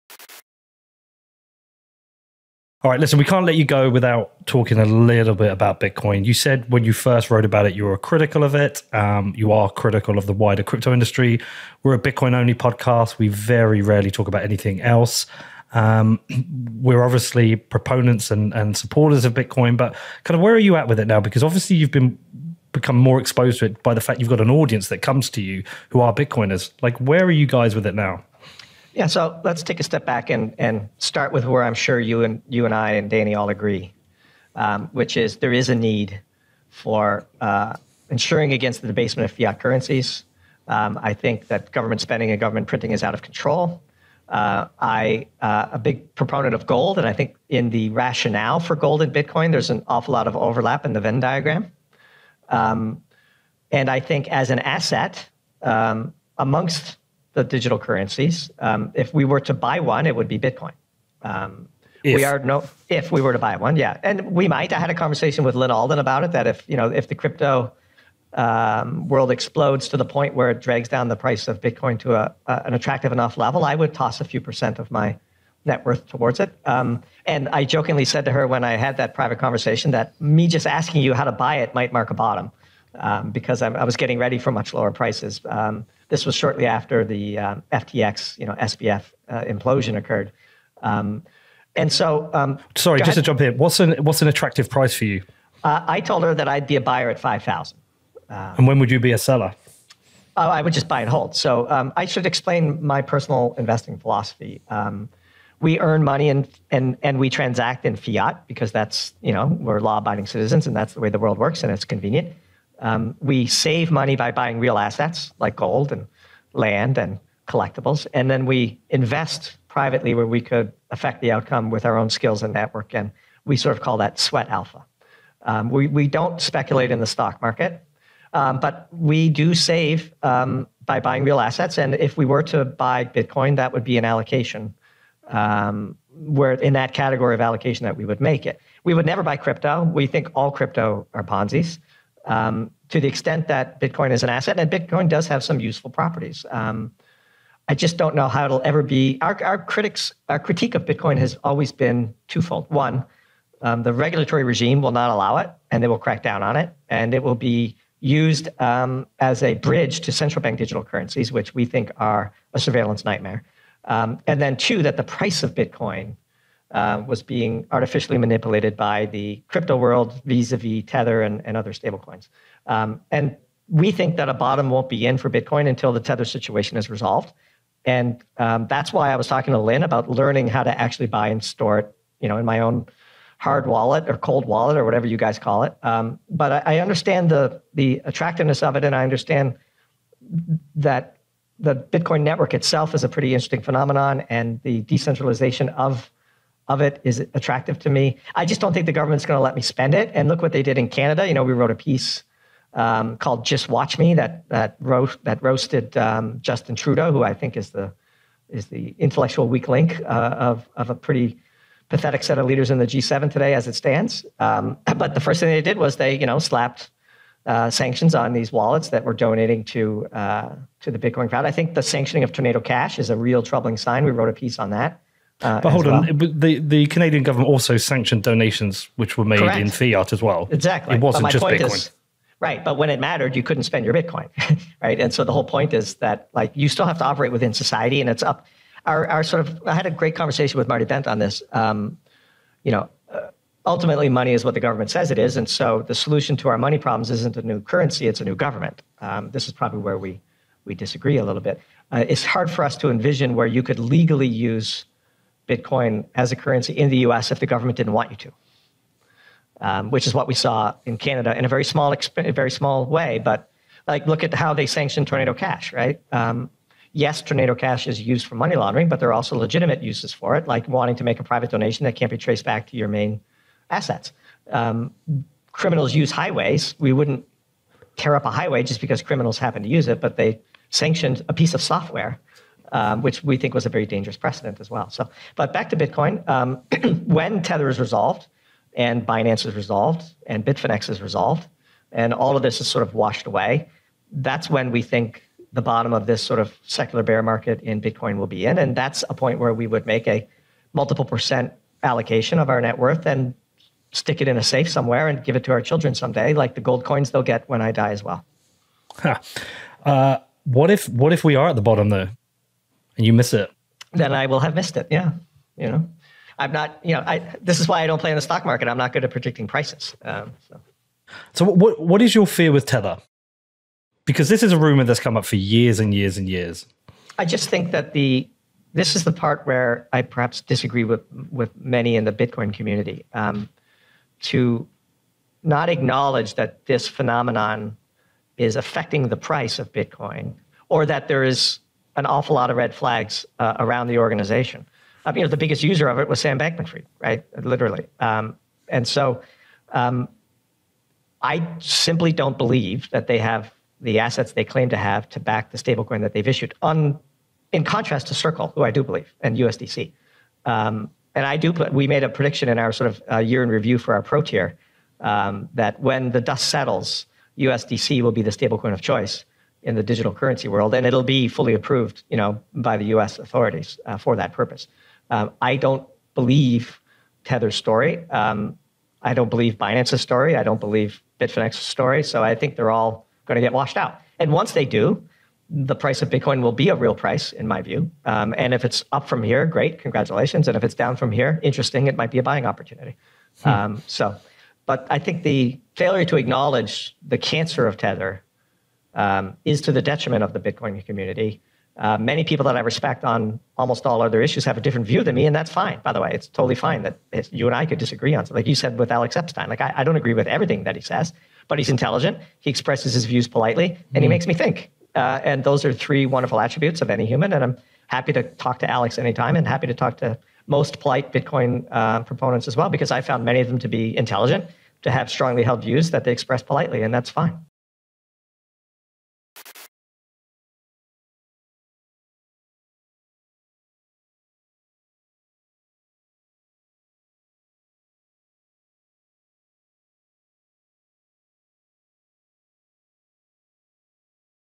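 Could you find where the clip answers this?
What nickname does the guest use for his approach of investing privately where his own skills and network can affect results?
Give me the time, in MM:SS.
02:04.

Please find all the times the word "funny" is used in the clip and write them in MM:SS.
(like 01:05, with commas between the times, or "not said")
not said.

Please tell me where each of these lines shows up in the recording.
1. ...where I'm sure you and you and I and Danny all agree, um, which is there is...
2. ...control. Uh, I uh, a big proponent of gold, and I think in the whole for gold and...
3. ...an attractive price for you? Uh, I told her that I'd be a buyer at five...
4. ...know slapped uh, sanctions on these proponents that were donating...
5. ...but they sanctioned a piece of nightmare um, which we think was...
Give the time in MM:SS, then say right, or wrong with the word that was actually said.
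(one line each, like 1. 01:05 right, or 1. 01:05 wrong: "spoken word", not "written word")
1. 00:31 right
2. 00:43 wrong: "rationale", not "whole"
3. 01:34 right
4. 03:36 wrong: "wallets", not "proponents"
5. 04:39 wrong: "software", not "nightmare".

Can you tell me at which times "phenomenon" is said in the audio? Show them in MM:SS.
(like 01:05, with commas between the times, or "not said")
03:13, 05:36.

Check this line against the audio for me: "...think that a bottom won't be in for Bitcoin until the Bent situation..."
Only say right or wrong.
wrong.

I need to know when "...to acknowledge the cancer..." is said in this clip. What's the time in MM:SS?
06:36.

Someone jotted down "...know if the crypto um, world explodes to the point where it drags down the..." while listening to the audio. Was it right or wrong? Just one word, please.
right.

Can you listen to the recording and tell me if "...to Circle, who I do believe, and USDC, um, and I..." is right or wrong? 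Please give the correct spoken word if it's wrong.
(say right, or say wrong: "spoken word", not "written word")
right.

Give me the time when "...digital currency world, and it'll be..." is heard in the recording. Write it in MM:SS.
06:09.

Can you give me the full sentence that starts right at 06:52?
He expresses his views politely, and mm he mm-hmm.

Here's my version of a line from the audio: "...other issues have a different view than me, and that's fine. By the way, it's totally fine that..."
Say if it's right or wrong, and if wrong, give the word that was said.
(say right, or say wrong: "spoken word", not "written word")
right.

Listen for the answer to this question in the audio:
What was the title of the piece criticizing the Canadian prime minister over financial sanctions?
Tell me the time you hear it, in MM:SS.
03:23.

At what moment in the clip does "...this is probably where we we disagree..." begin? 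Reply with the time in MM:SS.
04:09.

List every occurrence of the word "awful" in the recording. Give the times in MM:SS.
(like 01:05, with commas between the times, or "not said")
00:49, 05:42.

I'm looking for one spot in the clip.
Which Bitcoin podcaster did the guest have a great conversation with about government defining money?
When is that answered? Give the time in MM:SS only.
04:00.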